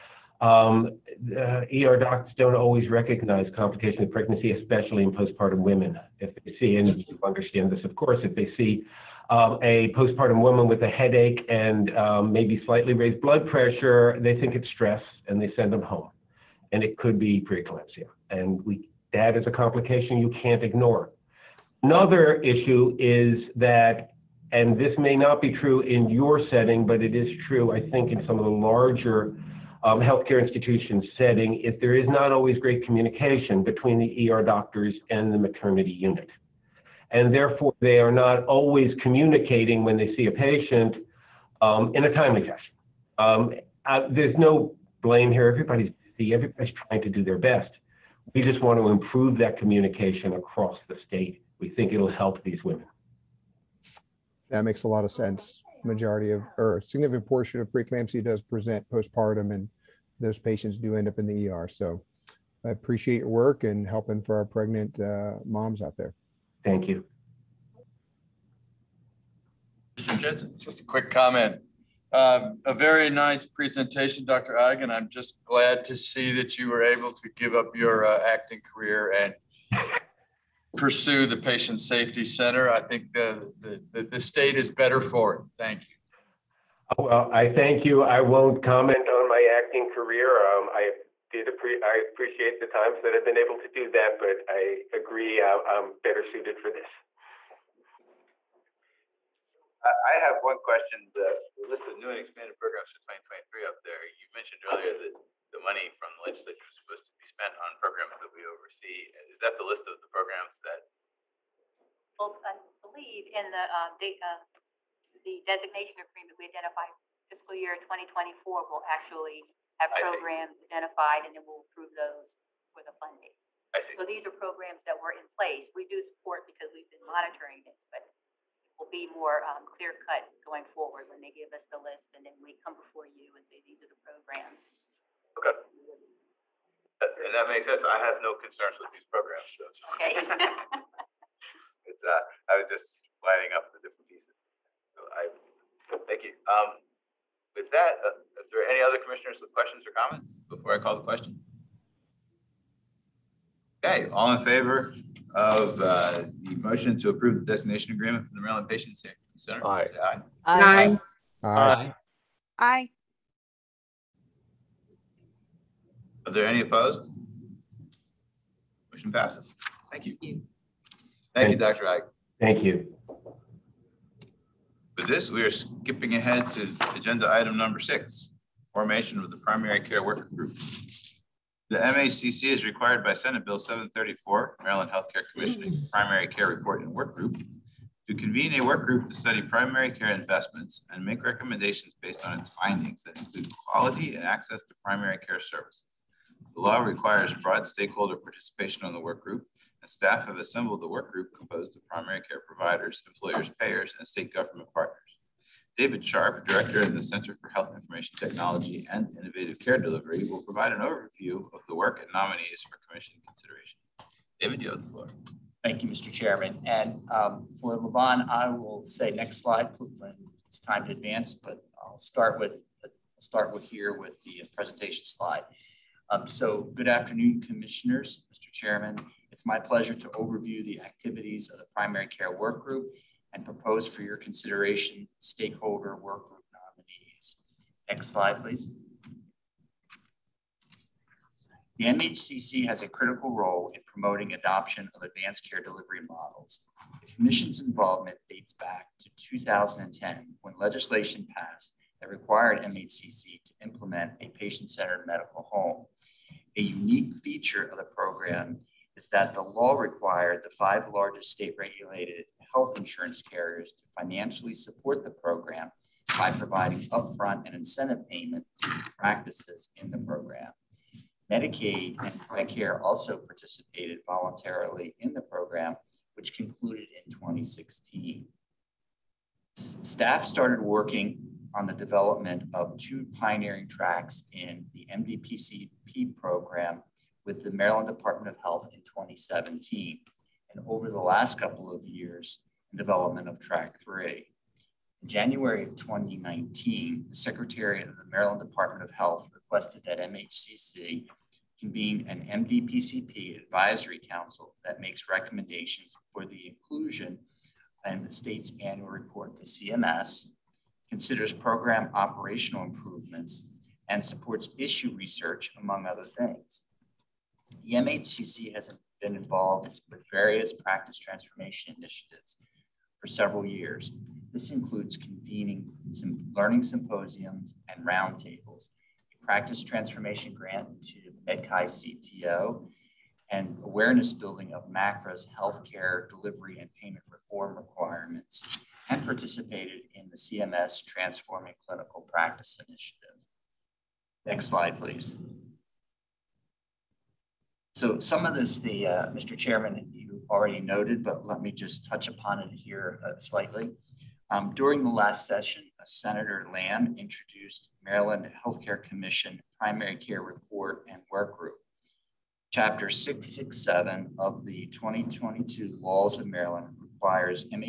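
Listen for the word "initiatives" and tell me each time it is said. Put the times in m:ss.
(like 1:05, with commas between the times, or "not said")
5:21, 5:42.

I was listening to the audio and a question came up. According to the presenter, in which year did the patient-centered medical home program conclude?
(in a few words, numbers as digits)
2016.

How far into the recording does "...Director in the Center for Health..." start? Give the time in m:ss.
3:26.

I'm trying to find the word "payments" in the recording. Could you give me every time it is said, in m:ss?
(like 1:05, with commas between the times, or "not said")
4:28, 5:36.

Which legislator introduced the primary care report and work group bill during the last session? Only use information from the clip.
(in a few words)
Senator Lam.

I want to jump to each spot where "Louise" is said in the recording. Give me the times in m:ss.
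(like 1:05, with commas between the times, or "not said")
not said.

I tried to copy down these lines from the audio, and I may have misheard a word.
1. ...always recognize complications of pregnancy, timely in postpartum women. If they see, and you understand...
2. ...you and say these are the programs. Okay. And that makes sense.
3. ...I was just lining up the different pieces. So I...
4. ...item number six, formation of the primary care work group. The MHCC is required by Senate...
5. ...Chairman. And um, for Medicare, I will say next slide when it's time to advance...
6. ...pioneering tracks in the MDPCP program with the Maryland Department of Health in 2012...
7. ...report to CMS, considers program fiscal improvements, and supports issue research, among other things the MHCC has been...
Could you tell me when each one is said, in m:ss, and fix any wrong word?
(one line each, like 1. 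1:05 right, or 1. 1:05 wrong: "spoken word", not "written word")
1. 0:02 wrong: "especially", not "timely"
2. 2:13 right
3. 2:22 right
4. 2:57 right
5. 3:36 wrong: "Levon", not "Medicare"
6. 4:43 wrong: "2017", not "2012"
7. 5:08 wrong: "operational", not "fiscal".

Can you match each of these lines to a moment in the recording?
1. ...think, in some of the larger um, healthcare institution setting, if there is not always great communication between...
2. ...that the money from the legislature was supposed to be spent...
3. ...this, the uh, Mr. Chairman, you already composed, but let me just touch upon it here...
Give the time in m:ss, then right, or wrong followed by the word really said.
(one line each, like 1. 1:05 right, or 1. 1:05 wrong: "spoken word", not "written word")
1. 0:27 right
2. 1:44 right
3. 5:48 wrong: "noted", not "composed".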